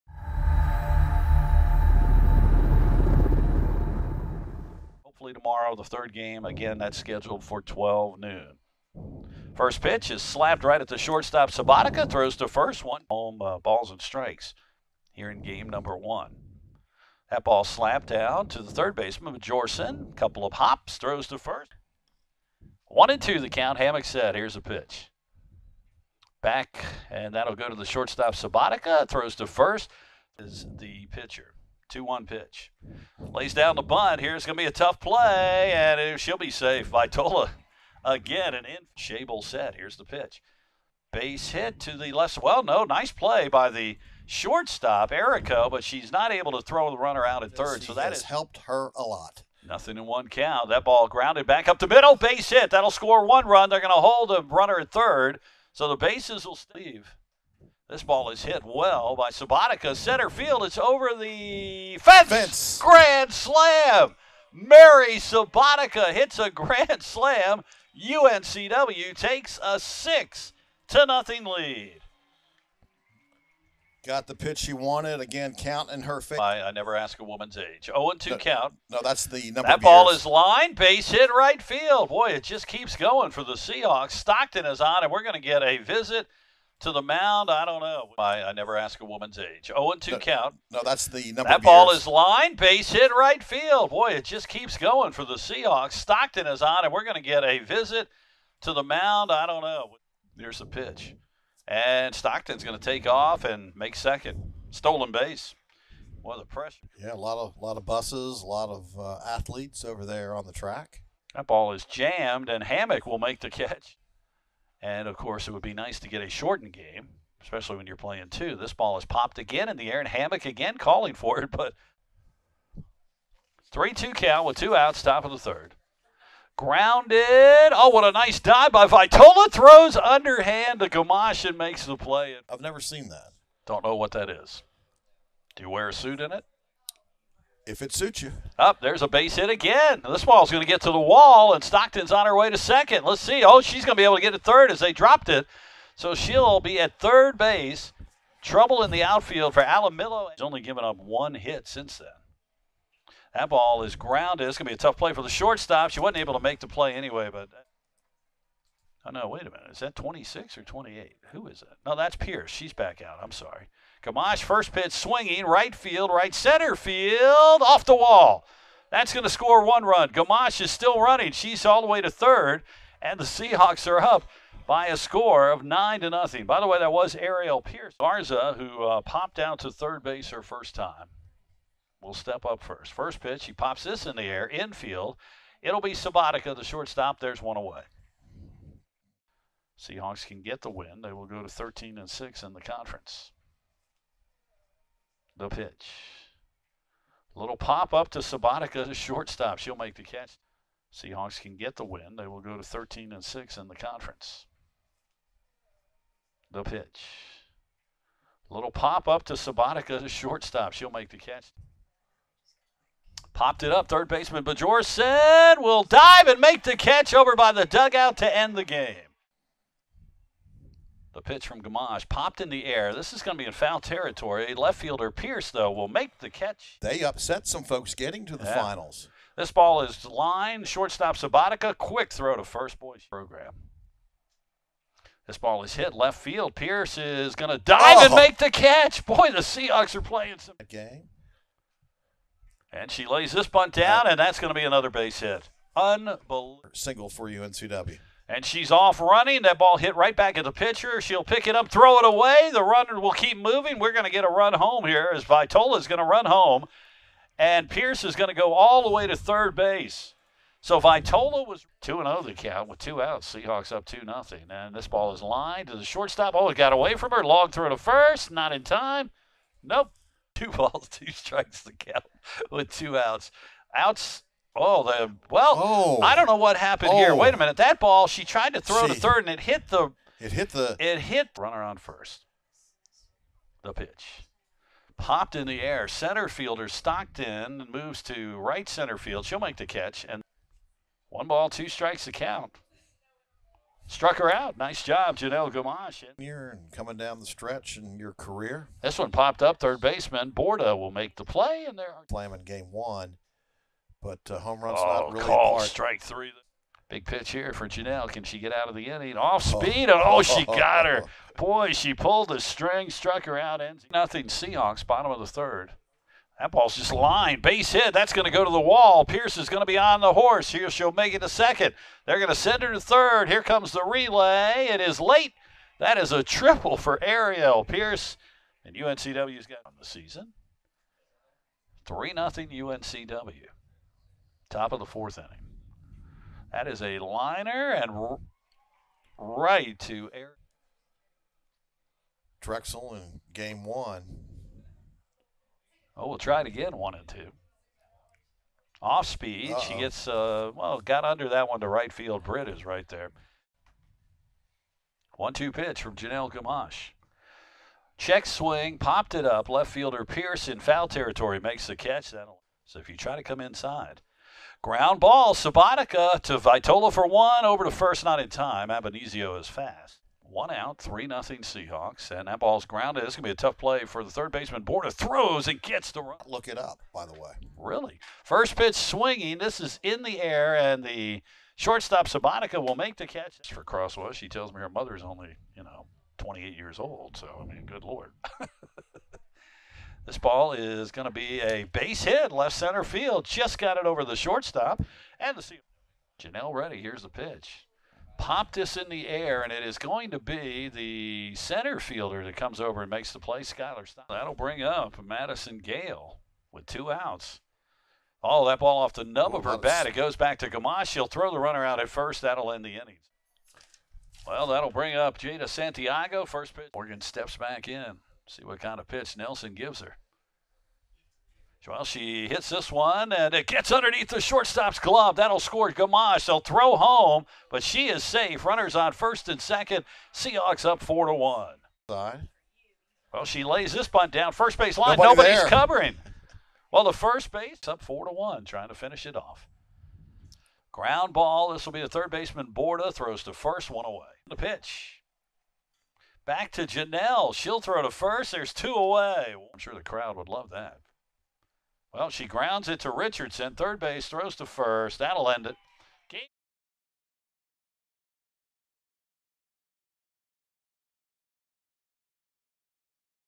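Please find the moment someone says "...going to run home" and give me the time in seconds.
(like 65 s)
255 s.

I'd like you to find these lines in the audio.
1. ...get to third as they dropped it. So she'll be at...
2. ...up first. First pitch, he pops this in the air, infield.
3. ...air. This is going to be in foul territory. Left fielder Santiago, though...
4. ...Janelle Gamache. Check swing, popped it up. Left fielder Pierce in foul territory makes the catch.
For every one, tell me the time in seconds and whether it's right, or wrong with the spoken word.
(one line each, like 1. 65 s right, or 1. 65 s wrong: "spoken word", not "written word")
1. 144 s right
2. 182 s right
3. 222 s wrong: "Pierce", not "Santiago"
4. 355 s right.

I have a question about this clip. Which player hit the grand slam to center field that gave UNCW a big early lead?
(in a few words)
Mary Sabatica.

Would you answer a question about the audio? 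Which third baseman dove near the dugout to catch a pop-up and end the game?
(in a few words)
Bajorsen.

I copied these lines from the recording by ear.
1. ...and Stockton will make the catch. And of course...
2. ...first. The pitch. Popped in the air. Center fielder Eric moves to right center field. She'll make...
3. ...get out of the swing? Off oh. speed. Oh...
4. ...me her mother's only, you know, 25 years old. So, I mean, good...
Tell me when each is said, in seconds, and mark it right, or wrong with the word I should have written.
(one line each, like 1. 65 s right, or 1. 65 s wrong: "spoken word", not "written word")
1. 112 s wrong: "Hammock", not "Stockton"
2. 281 s wrong: "Stockton", not "Eric"
3. 308 s wrong: "inning", not "swing"
4. 384 s wrong: "28", not "25".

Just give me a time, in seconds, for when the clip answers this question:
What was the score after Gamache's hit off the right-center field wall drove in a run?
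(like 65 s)
175 s.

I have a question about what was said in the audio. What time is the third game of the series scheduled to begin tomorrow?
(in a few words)
12 noon.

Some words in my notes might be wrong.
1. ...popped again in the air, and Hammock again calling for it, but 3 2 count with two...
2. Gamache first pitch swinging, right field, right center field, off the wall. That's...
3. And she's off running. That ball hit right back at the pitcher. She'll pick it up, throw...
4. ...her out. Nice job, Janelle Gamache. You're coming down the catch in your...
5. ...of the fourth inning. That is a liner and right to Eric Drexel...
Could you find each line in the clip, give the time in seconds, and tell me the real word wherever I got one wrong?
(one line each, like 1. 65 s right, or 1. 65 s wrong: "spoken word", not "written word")
1. 119 s right
2. 164 s right
3. 248 s right
4. 294 s wrong: "stretch", not "catch"
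5. 334 s right.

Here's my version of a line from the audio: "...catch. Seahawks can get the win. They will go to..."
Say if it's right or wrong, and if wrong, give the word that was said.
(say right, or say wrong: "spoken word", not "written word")
right.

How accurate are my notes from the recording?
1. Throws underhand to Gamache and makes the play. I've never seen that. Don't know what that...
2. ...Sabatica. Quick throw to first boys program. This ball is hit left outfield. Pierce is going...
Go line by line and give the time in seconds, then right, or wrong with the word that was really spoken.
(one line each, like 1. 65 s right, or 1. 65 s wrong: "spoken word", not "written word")
1. 129 s right
2. 231 s wrong: "field", not "outfield".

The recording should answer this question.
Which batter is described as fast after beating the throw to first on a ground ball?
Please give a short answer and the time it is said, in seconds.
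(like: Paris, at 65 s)
Abenizio, at 368 s.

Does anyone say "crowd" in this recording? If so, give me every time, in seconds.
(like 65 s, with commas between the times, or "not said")
449 s.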